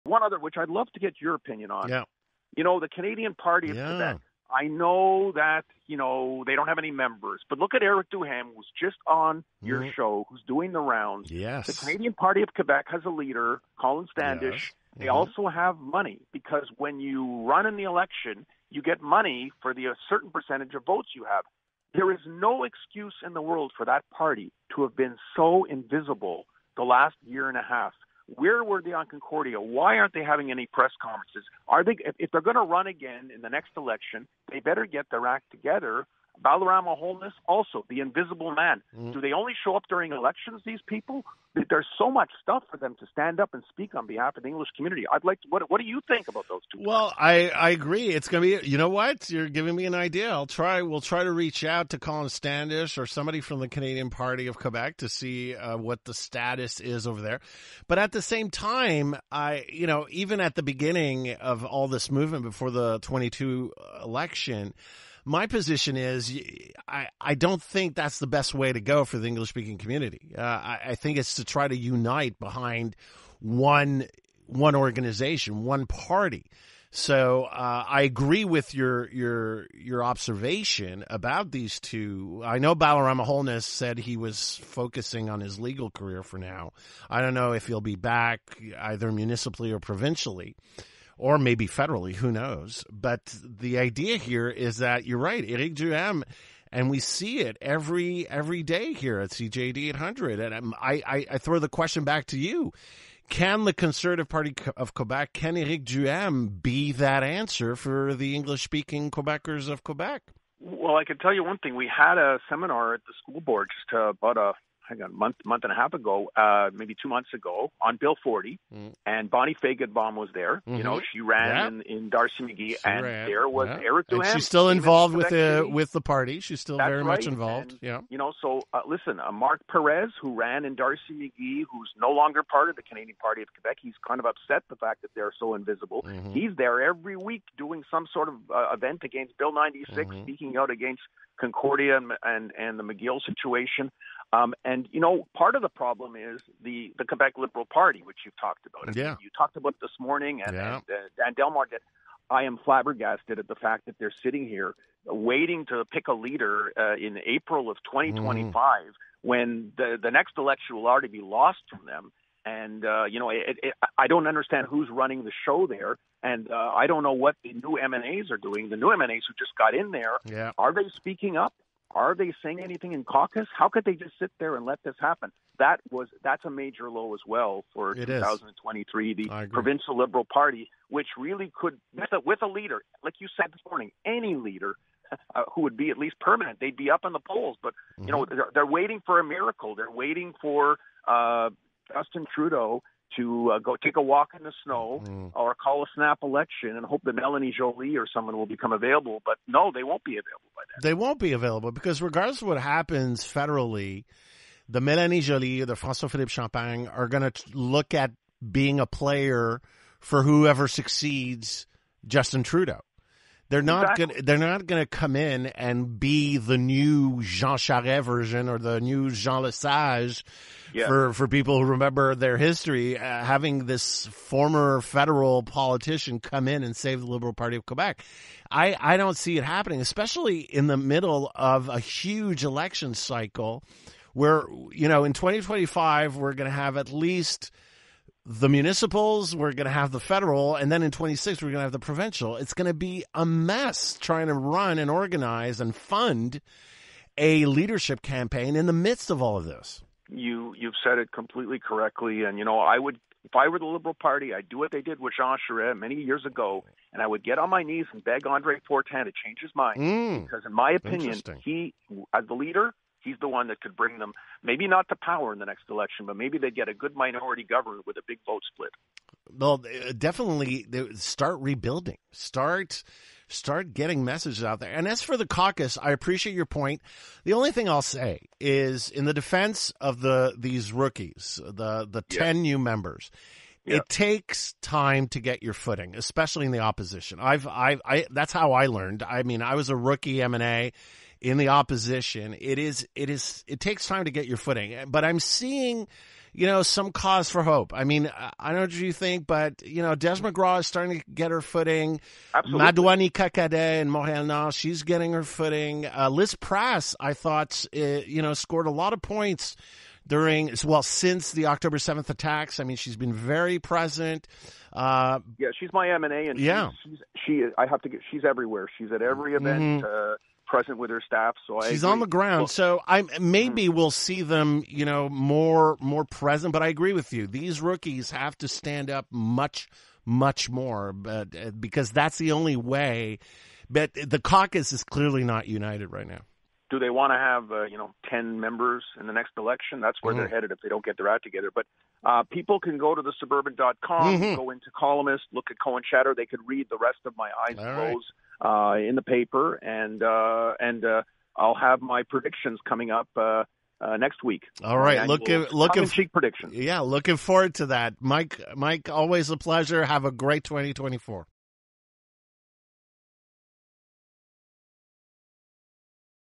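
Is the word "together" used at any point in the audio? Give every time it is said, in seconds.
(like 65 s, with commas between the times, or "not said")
35 s, 341 s.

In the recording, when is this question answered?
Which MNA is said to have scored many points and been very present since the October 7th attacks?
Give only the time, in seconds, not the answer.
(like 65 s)
306 s.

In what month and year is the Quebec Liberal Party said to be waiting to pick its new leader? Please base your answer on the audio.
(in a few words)
April 2025.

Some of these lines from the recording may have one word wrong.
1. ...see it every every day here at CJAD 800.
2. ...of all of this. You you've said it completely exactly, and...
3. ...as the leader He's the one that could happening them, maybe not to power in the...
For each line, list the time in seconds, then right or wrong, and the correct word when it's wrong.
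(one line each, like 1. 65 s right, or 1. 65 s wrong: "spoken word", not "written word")
1. 96 s right
2. 249 s wrong: "correctly", not "exactly"
3. 262 s wrong: "bring", not "happening".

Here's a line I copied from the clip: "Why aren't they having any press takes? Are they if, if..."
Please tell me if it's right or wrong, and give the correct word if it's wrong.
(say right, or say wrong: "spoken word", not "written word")
wrong: "conferences", not "takes".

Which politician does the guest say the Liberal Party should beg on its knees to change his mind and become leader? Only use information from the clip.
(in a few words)
Andre Fortin.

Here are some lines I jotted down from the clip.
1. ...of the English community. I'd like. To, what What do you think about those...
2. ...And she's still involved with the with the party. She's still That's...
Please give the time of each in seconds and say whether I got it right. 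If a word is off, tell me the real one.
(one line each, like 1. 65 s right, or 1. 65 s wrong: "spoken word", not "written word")
1. 44 s right
2. 124 s right.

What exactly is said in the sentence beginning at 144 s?
Um, and you know, part of the problem is the the Quebec Liberal Party, which you've talked about.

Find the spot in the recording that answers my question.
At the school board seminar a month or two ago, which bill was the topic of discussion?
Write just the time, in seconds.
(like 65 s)
117 s.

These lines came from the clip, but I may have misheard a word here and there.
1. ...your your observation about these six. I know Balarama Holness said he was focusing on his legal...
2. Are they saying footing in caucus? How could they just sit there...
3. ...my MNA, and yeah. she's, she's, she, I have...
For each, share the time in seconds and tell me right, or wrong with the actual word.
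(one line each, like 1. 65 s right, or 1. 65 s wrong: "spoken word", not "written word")
1. 79 s wrong: "two", not "six"
2. 171 s wrong: "anything", not "footing"
3. 315 s right.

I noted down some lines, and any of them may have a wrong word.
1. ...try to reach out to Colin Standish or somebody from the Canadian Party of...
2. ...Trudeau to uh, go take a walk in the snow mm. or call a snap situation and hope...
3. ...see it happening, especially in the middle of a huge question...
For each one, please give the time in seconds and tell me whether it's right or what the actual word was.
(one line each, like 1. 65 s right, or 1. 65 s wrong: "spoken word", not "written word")
1. 51 s right
2. 192 s wrong: "election", not "situation"
3. 229 s wrong: "election", not "question".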